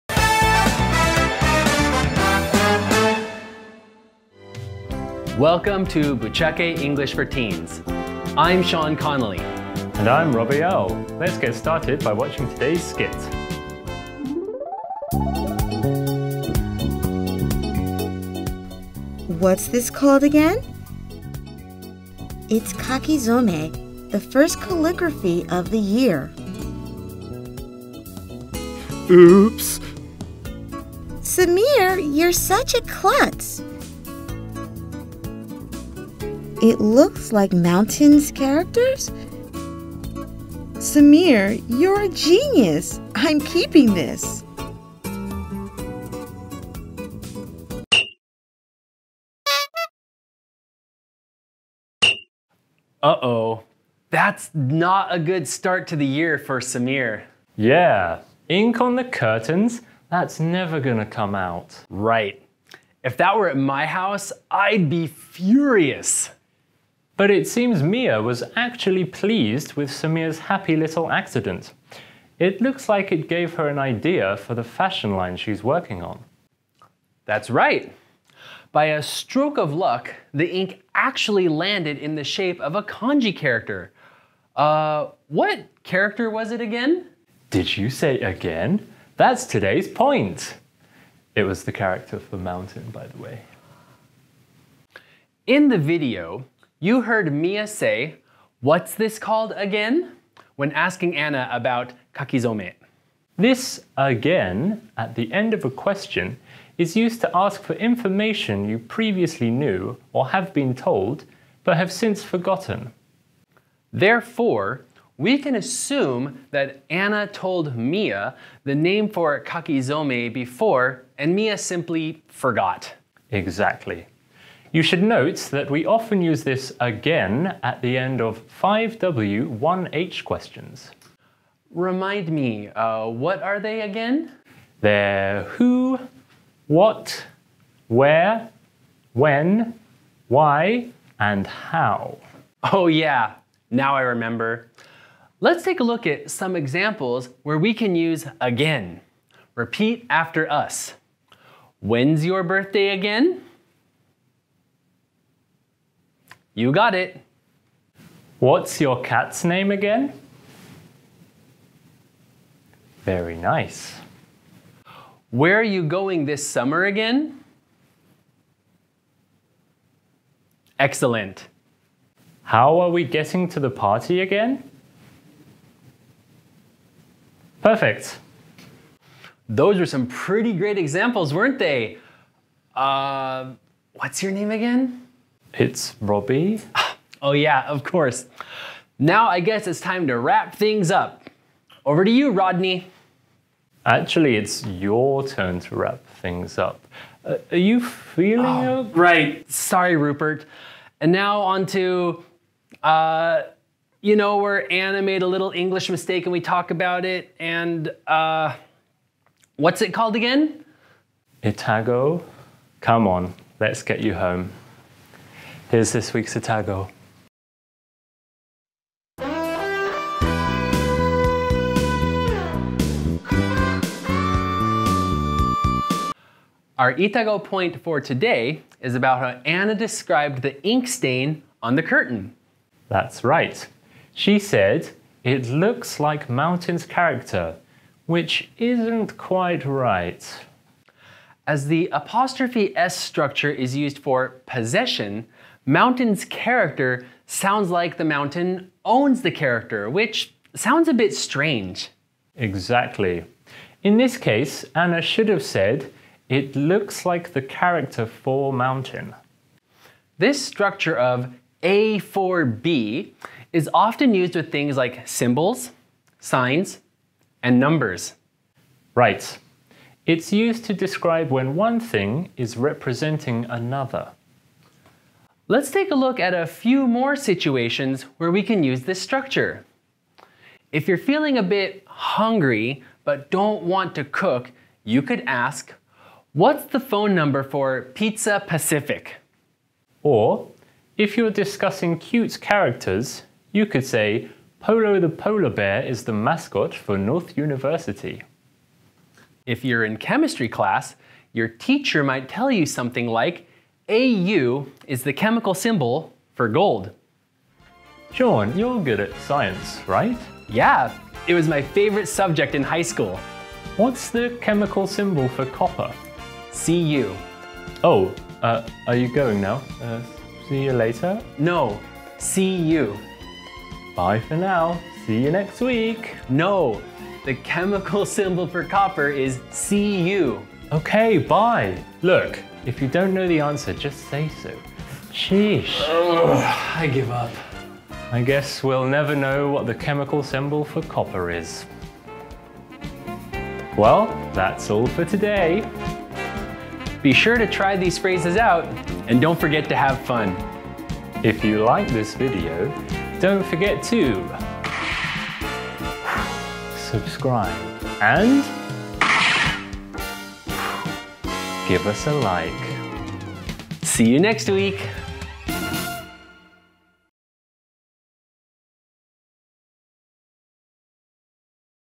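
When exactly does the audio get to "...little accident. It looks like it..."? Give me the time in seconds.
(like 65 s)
70 s.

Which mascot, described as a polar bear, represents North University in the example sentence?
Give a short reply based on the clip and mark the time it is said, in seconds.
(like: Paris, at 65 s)
Polo, at 294 s.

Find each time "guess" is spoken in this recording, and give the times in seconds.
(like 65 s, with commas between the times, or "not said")
189 s, 338 s.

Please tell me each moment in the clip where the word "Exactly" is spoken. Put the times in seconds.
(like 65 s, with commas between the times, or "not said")
123 s, 252 s.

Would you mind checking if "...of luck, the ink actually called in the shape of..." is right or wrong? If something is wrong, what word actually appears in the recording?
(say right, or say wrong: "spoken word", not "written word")
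wrong: "landed", not "called".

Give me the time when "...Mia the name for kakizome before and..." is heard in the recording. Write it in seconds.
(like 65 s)
117 s.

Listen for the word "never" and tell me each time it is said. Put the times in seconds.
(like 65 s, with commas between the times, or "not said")
60 s, 338 s.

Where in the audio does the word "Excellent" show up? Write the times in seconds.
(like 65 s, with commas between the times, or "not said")
170 s.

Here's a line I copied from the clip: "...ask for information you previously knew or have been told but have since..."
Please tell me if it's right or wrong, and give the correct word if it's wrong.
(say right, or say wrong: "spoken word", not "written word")
right.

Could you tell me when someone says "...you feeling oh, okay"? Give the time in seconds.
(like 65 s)
197 s.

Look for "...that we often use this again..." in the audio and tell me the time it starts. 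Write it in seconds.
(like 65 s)
125 s.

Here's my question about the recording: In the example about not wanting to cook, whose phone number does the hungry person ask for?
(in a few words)
Pizza Pacific.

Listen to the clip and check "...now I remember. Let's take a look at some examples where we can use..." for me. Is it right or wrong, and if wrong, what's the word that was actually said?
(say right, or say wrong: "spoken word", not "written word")
right.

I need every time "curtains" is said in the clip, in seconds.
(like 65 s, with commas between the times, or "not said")
59 s, 231 s.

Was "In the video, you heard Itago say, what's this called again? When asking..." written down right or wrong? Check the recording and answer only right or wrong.
wrong.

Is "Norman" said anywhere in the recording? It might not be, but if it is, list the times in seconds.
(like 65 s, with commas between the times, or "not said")
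not said.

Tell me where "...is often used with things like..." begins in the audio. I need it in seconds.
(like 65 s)
263 s.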